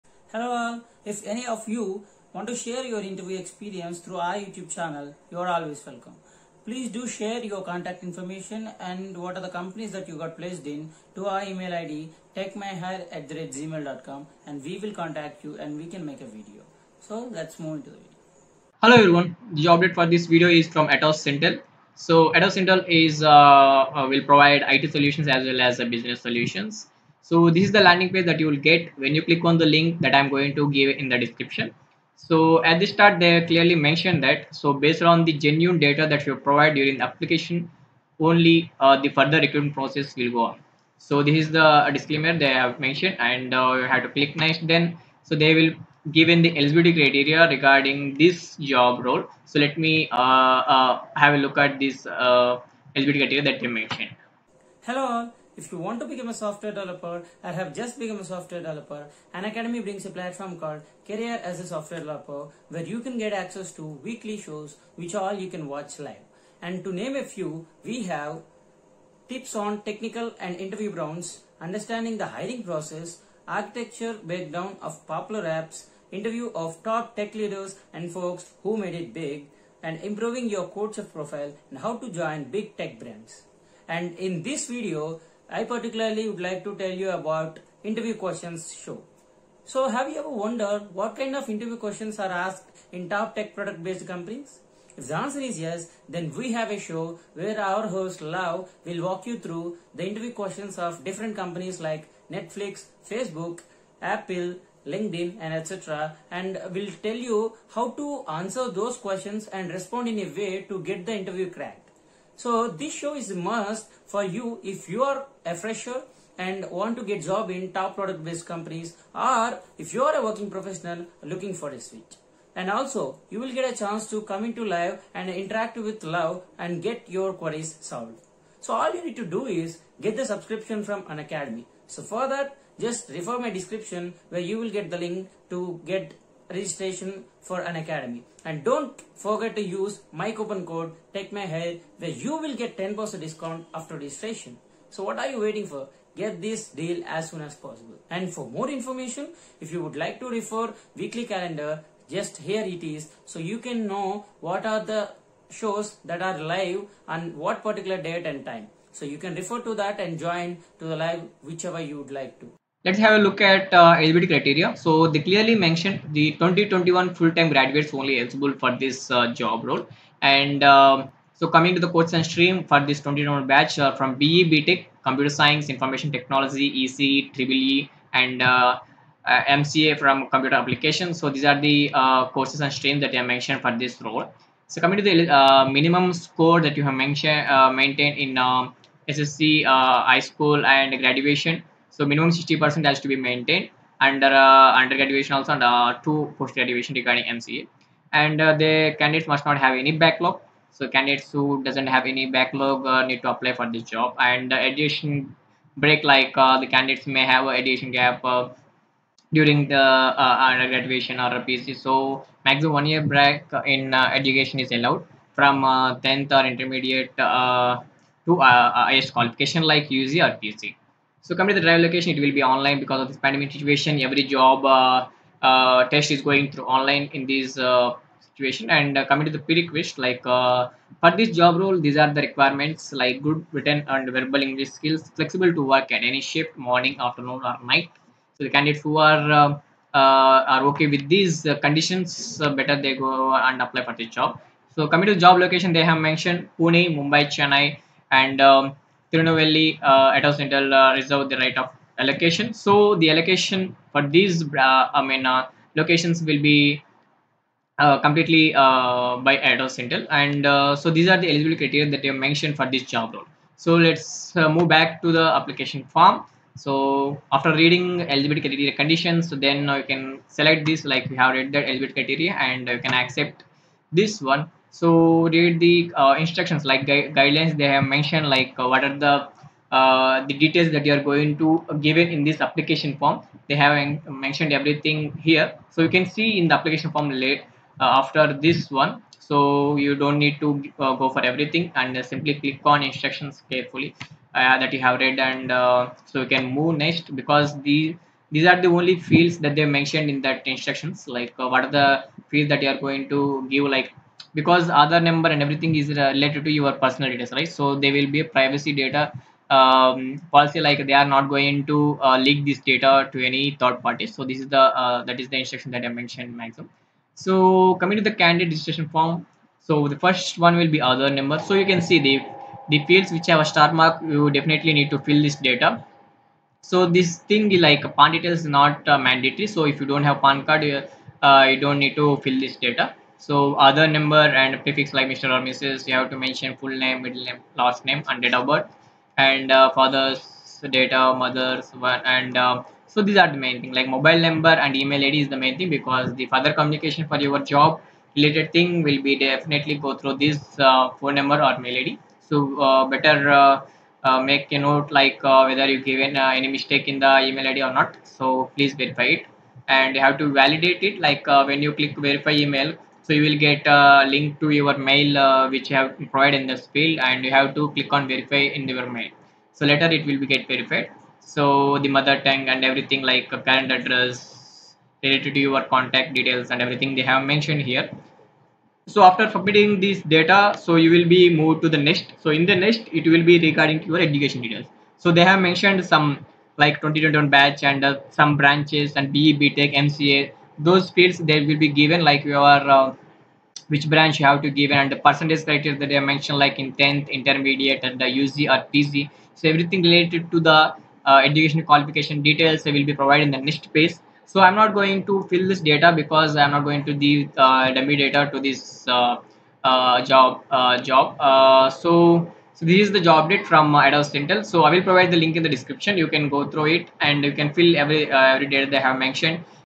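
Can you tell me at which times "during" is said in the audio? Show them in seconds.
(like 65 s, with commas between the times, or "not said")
36 s, 209 s.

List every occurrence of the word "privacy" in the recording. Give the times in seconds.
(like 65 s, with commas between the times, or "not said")
308 s.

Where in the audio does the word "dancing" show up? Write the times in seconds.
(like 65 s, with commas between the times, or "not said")
not said.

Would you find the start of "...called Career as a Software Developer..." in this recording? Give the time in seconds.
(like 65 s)
60 s.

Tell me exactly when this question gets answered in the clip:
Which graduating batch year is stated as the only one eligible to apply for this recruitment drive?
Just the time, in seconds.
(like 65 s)
166 s.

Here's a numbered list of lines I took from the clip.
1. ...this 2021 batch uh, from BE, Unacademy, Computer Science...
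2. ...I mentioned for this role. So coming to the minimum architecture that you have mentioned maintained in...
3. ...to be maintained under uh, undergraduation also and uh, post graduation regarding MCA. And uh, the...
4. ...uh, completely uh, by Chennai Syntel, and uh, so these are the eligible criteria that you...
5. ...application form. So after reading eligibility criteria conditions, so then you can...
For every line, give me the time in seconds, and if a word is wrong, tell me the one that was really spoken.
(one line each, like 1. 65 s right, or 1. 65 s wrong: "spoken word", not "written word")
1. 172 s wrong: "BTech", not "Unacademy"
2. 183 s wrong: "score", not "architecture"
3. 193 s right
4. 257 s wrong: "Atos", not "Chennai"
5. 265 s right.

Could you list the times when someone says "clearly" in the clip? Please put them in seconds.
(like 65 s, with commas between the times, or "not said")
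33 s, 165 s.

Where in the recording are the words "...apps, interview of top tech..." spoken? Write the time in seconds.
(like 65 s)
75 s.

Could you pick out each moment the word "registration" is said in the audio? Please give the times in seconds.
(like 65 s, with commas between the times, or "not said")
136 s, 143 s, 318 s.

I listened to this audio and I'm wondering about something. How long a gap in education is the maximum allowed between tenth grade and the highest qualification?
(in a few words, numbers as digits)
One year.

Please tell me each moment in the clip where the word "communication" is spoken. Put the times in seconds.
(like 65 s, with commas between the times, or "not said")
346 s.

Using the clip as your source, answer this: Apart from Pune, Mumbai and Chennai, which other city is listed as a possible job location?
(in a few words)
Tirunelveli.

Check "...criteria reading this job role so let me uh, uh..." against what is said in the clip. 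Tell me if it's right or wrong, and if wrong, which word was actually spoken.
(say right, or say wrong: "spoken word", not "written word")
wrong: "regarding", not "reading".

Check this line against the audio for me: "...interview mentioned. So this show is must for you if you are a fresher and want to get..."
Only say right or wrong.
wrong.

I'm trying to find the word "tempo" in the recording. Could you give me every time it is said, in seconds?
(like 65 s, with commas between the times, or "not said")
not said.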